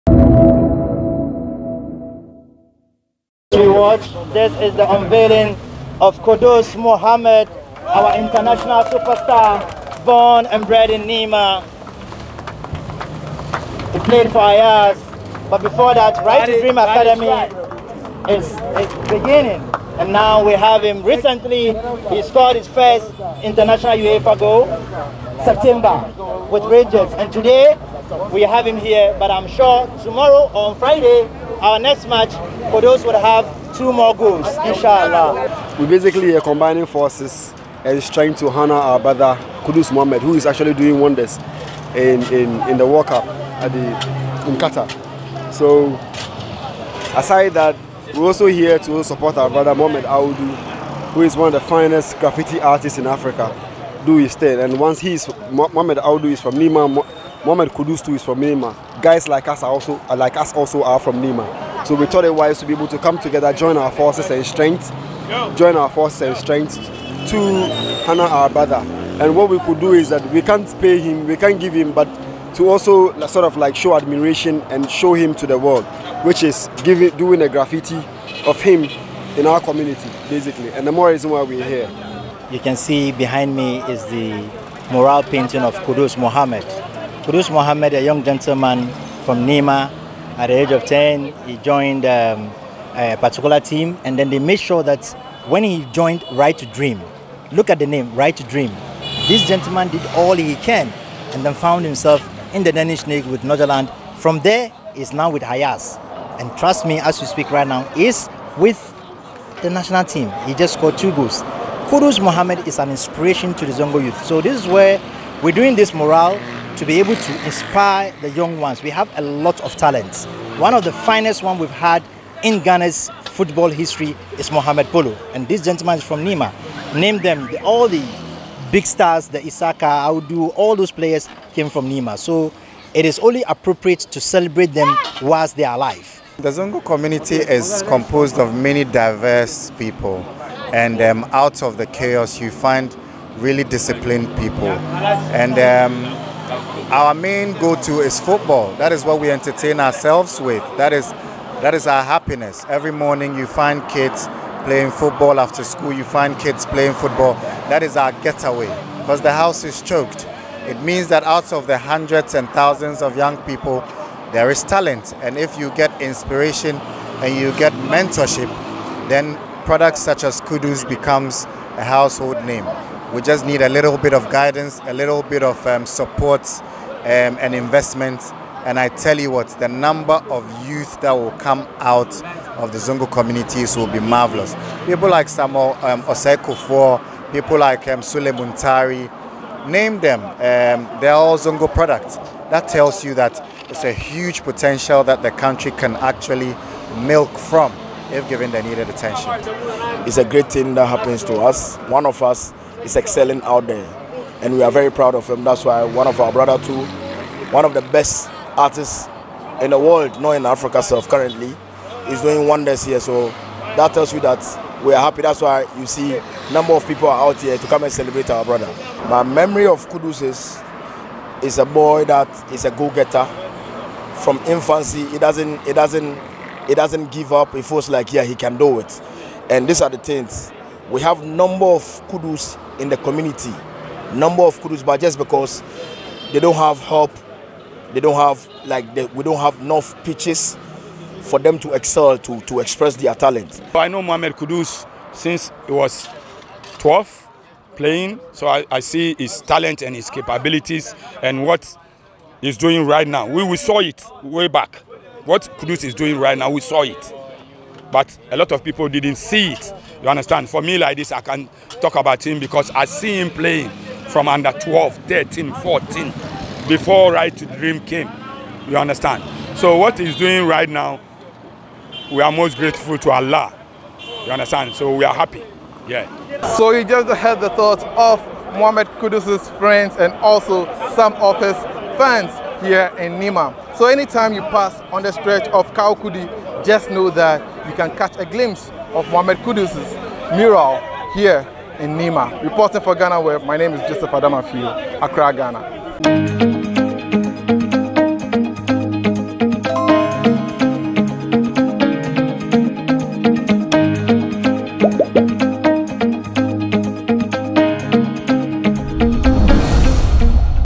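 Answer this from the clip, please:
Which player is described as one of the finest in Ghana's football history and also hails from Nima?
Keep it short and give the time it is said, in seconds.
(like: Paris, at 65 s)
Mohamed Polo, at 124 s.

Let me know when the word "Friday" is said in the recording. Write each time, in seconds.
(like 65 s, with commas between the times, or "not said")
30 s.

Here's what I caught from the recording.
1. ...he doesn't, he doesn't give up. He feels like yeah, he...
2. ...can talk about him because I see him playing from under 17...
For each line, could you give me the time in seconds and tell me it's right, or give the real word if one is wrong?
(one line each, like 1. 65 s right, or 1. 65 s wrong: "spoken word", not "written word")
1. 225 s right
2. 261 s wrong: "12", not "17".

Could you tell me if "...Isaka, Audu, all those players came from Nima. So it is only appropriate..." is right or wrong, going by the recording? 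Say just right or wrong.
right.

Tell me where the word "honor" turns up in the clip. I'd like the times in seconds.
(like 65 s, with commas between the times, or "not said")
38 s, 68 s.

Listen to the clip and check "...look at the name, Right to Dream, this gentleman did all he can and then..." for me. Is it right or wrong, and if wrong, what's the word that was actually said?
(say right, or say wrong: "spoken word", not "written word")
right.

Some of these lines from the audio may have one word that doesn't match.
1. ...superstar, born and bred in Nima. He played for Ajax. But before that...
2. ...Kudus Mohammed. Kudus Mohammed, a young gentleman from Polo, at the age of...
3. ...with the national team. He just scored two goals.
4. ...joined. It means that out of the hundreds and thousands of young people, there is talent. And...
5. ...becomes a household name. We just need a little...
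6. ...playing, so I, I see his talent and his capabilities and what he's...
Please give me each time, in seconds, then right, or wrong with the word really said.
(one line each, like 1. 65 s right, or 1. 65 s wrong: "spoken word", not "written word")
1. 8 s right
2. 85 s wrong: "Nima", not "Polo"
3. 108 s right
4. 159 s wrong: "choked", not "joined"
5. 170 s right
6. 247 s right.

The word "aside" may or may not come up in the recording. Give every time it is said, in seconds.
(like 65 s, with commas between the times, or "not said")
47 s.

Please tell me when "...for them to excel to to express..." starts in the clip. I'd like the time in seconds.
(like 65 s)
241 s.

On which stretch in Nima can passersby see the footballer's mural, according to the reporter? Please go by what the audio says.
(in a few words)
Kawukudi.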